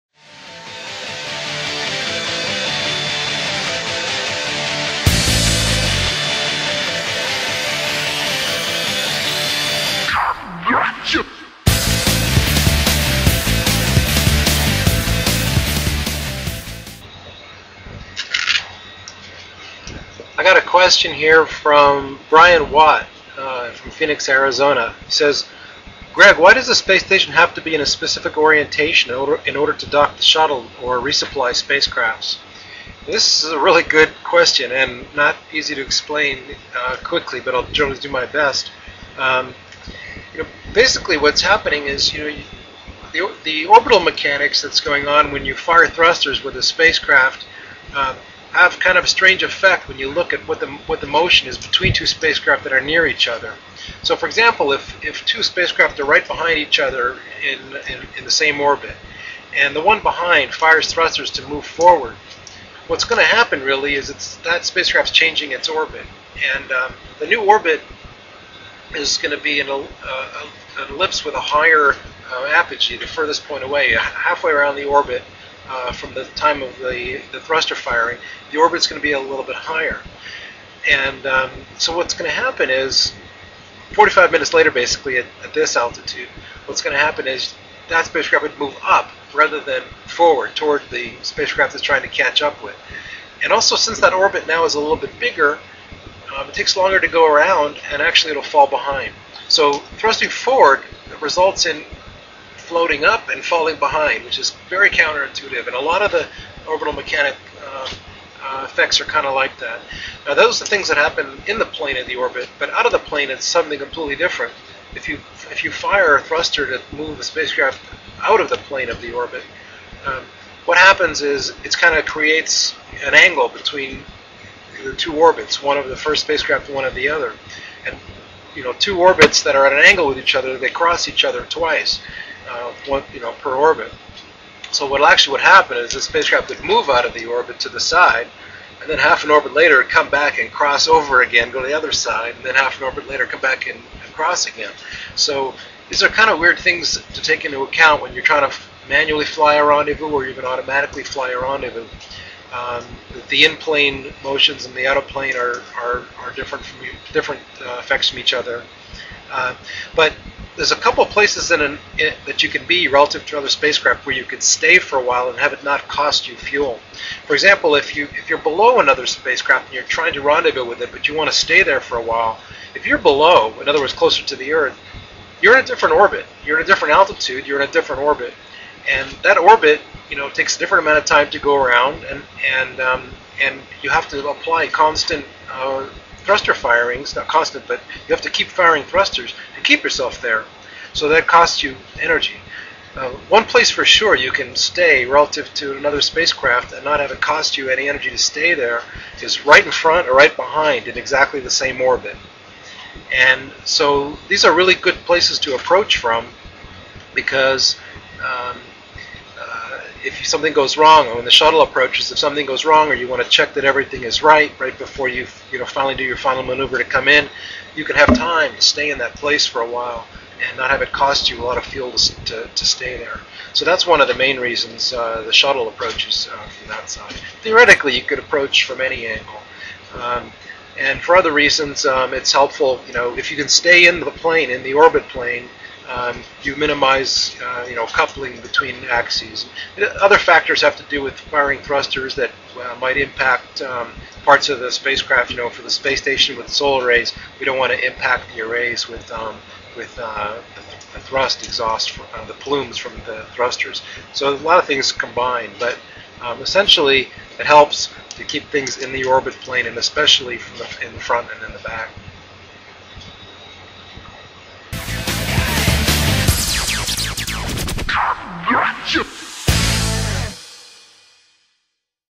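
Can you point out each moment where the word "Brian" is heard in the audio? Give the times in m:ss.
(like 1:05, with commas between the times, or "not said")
0:22.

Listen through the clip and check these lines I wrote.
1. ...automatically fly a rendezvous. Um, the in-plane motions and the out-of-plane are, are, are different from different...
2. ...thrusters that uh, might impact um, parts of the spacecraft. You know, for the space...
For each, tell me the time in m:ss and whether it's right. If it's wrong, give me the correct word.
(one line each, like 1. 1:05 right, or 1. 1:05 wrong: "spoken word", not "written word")
1. 2:30 right
2. 4:01 right.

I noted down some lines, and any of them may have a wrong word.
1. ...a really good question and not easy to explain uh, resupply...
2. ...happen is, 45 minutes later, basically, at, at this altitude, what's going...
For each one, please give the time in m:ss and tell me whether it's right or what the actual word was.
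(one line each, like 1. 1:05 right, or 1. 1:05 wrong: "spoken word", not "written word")
1. 0:33 wrong: "quickly", not "resupply"
2. 1:22 right.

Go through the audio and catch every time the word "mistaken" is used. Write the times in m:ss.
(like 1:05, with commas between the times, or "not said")
not said.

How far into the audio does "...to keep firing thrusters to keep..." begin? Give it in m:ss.
3:08.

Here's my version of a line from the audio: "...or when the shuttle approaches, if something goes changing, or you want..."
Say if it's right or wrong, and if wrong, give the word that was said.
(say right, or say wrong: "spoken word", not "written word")
wrong: "wrong", not "changing".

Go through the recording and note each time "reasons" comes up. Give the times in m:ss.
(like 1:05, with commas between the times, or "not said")
3:44, 3:51.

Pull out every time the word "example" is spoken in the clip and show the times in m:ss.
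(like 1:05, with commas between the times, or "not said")
0:54, 2:47.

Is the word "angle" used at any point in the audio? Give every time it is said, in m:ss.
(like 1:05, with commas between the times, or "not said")
2:03, 2:09, 3:49.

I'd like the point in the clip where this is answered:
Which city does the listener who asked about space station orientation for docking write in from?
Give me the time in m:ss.
0:23.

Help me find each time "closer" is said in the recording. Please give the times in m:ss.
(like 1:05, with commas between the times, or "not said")
2:53.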